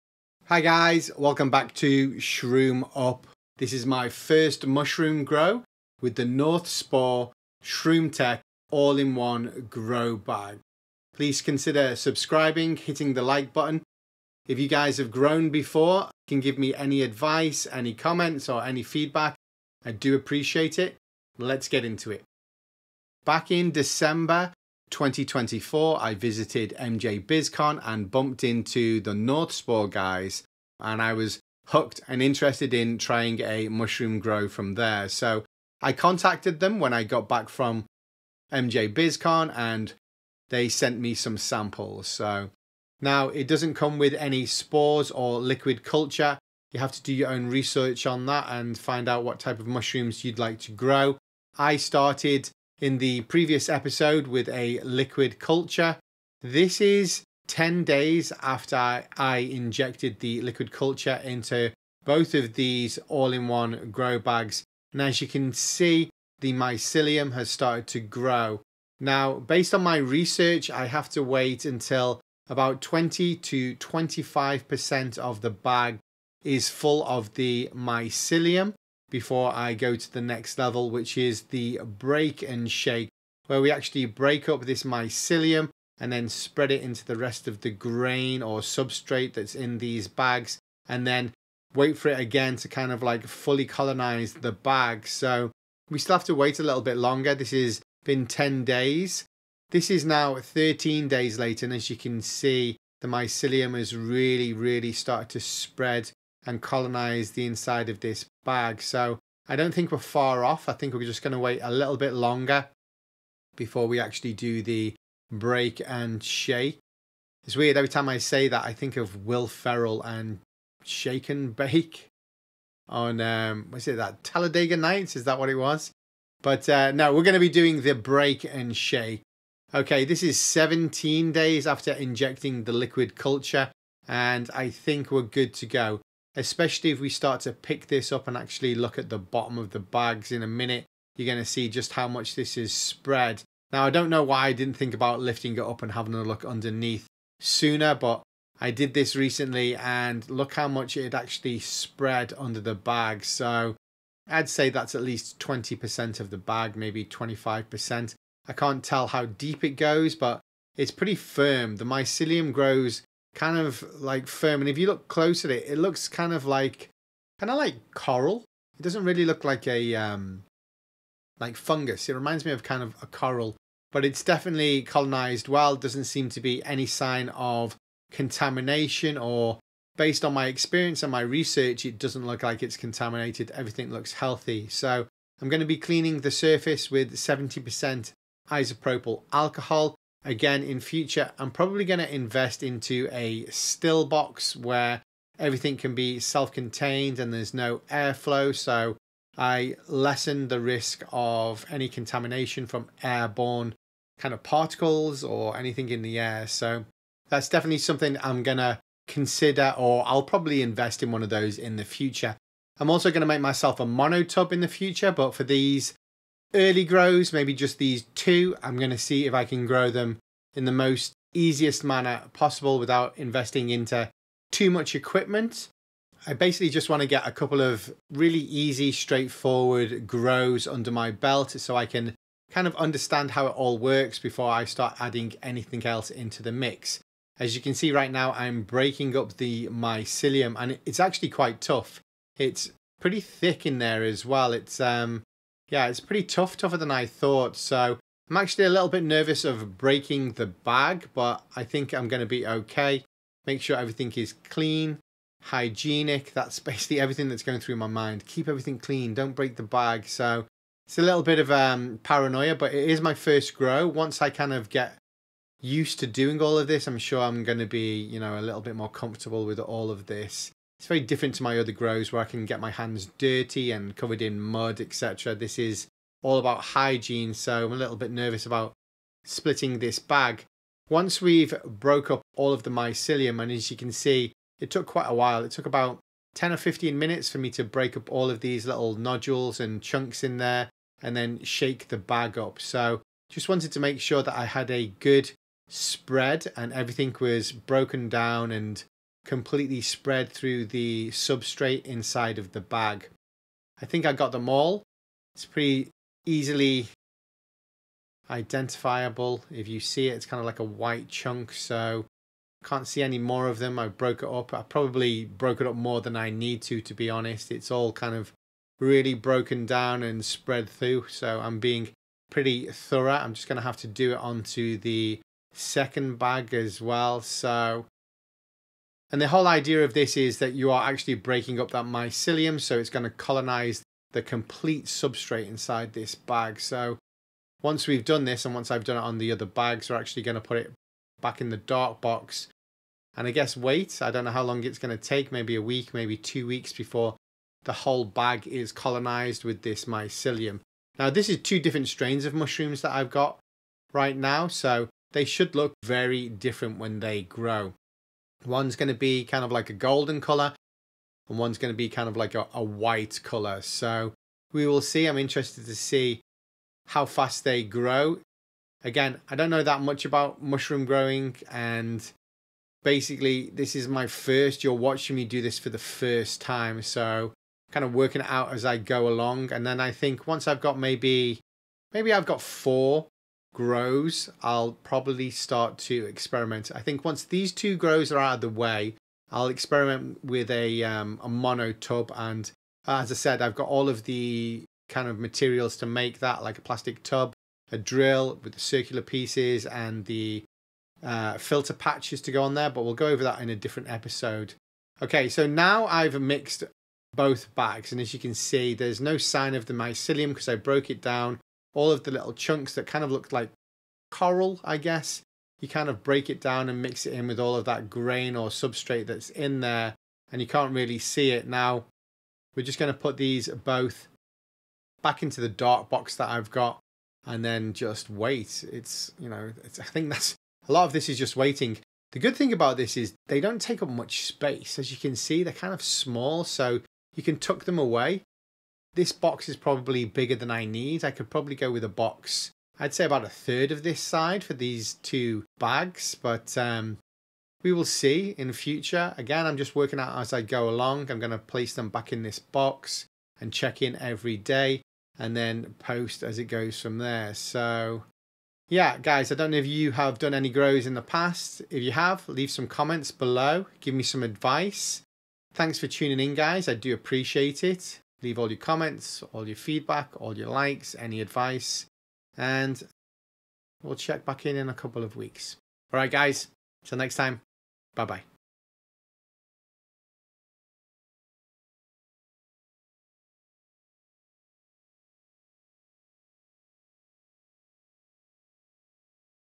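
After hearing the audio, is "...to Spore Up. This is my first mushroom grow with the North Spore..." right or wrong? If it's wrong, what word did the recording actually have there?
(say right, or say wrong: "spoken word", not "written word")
wrong: "Shroom", not "Spore".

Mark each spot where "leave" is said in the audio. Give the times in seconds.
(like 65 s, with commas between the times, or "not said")
462 s, 468 s.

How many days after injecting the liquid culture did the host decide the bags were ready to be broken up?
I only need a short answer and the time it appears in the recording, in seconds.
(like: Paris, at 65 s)
17, at 130 s.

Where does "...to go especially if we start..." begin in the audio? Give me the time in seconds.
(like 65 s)
135 s.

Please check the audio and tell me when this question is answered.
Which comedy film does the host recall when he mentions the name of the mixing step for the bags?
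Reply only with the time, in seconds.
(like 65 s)
124 s.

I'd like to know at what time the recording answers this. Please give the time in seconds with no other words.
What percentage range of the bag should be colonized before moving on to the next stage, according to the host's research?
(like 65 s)
72 s.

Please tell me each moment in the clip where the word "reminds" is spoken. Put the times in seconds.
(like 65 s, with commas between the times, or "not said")
172 s.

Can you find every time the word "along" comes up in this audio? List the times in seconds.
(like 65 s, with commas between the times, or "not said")
379 s, 450 s.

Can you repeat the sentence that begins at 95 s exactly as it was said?
So we still have to wait a little bit longer.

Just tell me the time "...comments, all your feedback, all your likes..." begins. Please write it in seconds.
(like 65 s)
468 s.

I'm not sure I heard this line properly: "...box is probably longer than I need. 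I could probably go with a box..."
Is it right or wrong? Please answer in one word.
wrong.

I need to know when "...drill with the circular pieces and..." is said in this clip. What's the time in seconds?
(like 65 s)
397 s.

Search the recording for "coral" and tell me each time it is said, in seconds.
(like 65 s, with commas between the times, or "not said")
167 s, 173 s, 414 s.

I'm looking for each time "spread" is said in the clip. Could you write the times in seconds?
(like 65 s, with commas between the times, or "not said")
86 s, 105 s, 142 s, 151 s, 295 s, 299 s, 320 s.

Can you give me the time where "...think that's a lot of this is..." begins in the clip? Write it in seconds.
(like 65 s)
429 s.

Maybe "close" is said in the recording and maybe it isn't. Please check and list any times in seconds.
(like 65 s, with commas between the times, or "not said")
165 s.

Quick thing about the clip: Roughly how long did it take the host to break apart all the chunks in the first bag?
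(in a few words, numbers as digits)
10 or 15 minutes.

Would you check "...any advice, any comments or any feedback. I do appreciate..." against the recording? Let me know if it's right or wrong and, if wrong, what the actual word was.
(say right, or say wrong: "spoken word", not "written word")
right.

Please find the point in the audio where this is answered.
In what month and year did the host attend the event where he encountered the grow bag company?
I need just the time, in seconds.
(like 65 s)
23 s.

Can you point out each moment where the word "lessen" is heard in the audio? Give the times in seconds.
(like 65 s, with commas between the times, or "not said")
199 s.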